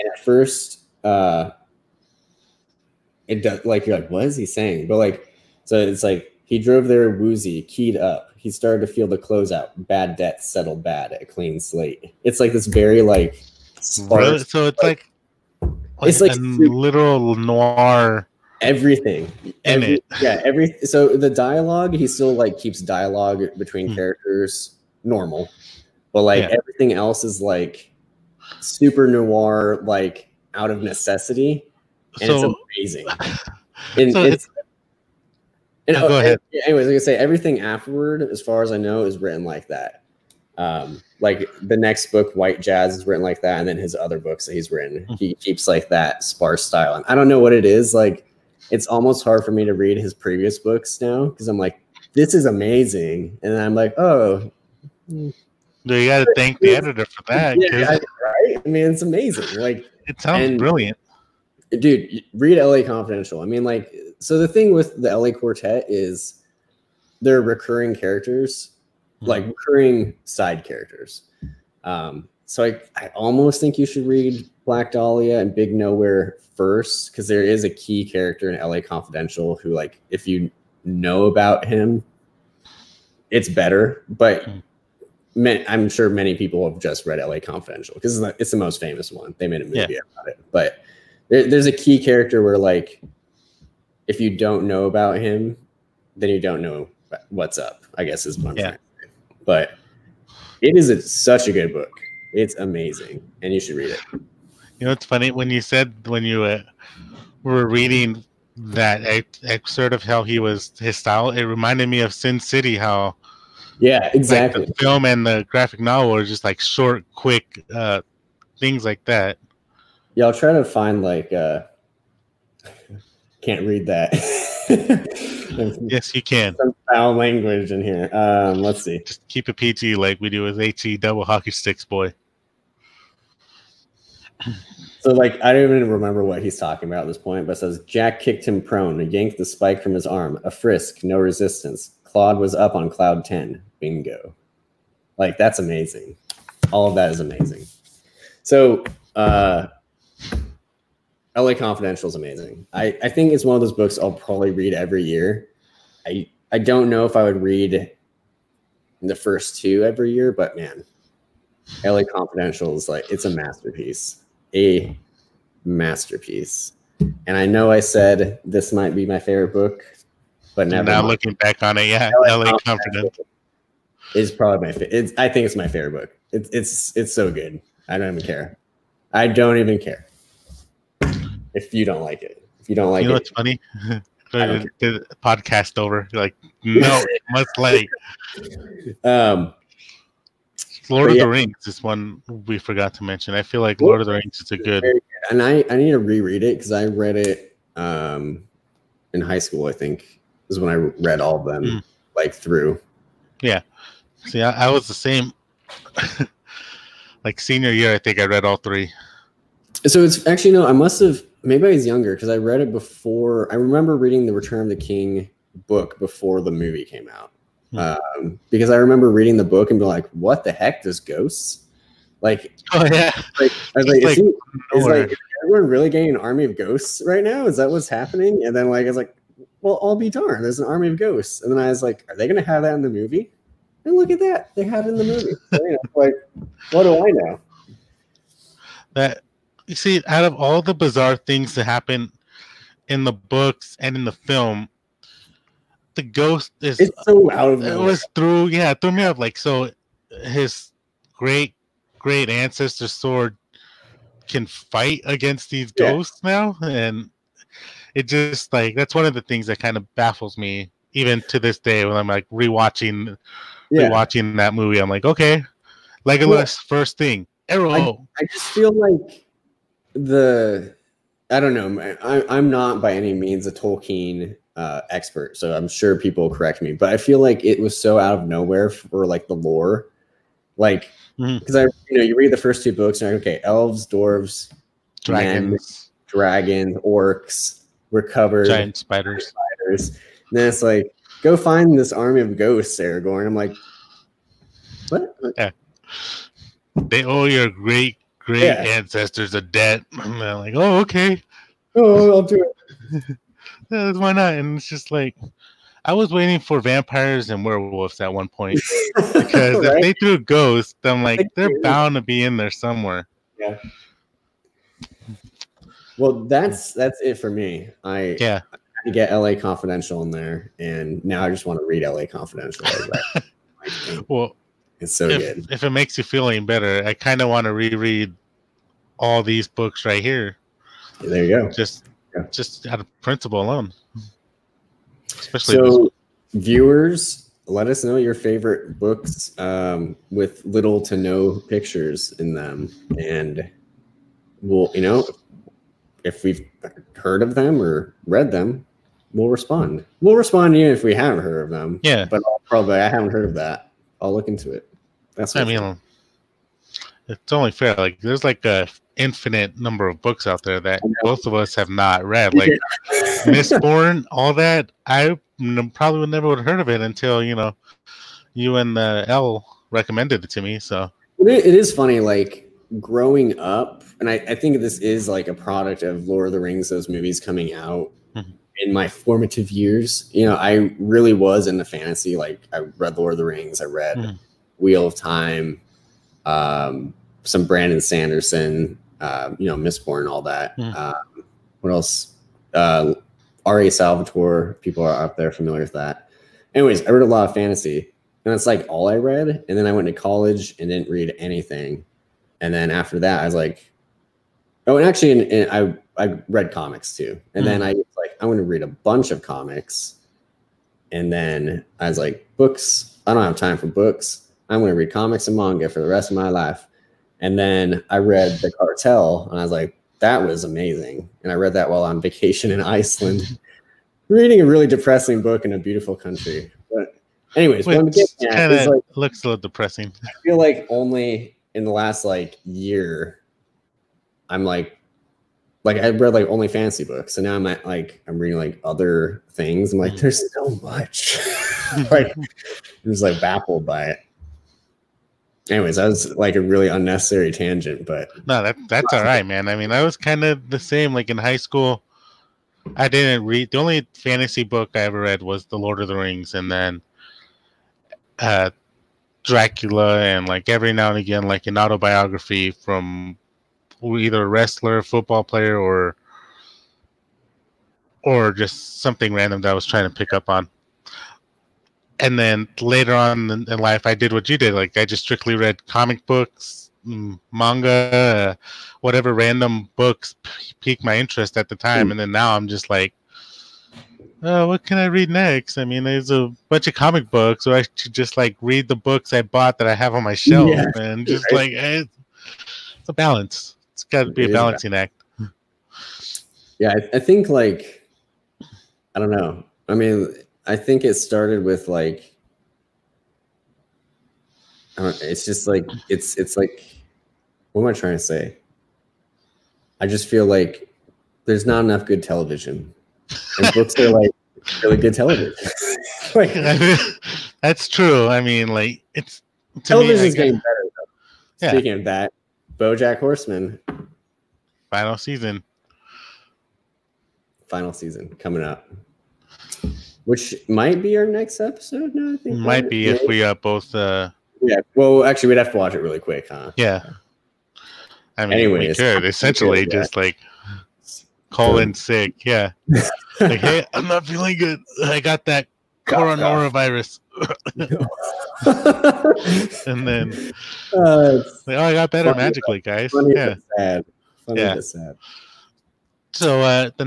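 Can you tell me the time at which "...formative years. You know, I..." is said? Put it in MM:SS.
06:18.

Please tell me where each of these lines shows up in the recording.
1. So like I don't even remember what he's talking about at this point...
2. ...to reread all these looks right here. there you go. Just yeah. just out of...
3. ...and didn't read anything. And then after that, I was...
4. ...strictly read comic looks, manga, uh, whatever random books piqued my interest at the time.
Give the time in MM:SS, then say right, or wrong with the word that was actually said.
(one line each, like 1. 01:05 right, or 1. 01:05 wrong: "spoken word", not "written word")
1. 02:15 right
2. 05:27 wrong: "books", not "looks"
3. 06:40 right
4. 07:55 wrong: "books", not "looks".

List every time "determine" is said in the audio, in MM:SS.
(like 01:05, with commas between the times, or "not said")
not said.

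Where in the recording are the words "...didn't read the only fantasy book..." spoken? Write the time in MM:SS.
07:32.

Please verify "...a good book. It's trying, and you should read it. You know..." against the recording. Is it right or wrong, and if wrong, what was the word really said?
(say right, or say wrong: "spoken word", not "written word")
wrong: "amazing", not "trying".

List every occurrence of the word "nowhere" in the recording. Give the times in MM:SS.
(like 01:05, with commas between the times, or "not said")
01:15, 04:38.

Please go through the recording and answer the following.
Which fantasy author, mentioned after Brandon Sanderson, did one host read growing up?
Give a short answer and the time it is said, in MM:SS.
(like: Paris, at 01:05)
R.A. Salvatore, at 06:33.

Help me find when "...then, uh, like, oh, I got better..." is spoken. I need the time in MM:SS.
09:09.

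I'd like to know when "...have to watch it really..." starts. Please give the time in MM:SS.
08:55.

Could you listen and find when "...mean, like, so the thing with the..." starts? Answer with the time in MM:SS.
01:03.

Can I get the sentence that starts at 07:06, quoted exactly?
But, anyways, Which at, like, looks a little depressing.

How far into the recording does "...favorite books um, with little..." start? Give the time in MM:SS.
05:38.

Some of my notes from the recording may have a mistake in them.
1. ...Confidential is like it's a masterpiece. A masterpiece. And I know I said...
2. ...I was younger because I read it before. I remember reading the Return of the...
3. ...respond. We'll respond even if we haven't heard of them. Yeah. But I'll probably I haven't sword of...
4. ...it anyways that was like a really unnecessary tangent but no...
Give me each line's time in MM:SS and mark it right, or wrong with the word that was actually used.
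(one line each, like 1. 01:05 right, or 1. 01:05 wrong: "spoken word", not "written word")
1. 02:42 right
2. 03:31 right
3. 05:49 wrong: "heard", not "sword"
4. 07:23 right.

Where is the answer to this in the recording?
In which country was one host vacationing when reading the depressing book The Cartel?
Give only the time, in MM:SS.
07:02.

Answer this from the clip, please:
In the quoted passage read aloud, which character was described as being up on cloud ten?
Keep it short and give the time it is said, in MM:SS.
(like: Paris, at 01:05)
Claude, at 02:22.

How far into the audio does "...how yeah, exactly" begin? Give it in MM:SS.
01:52.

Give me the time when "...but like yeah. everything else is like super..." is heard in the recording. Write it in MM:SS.
00:26.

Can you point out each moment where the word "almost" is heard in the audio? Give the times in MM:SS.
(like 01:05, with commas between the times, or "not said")
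00:48, 01:13.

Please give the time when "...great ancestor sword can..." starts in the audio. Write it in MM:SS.
04:11.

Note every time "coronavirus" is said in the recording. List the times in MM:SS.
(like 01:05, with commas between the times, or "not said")
09:05.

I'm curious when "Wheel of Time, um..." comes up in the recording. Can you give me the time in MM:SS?
06:24.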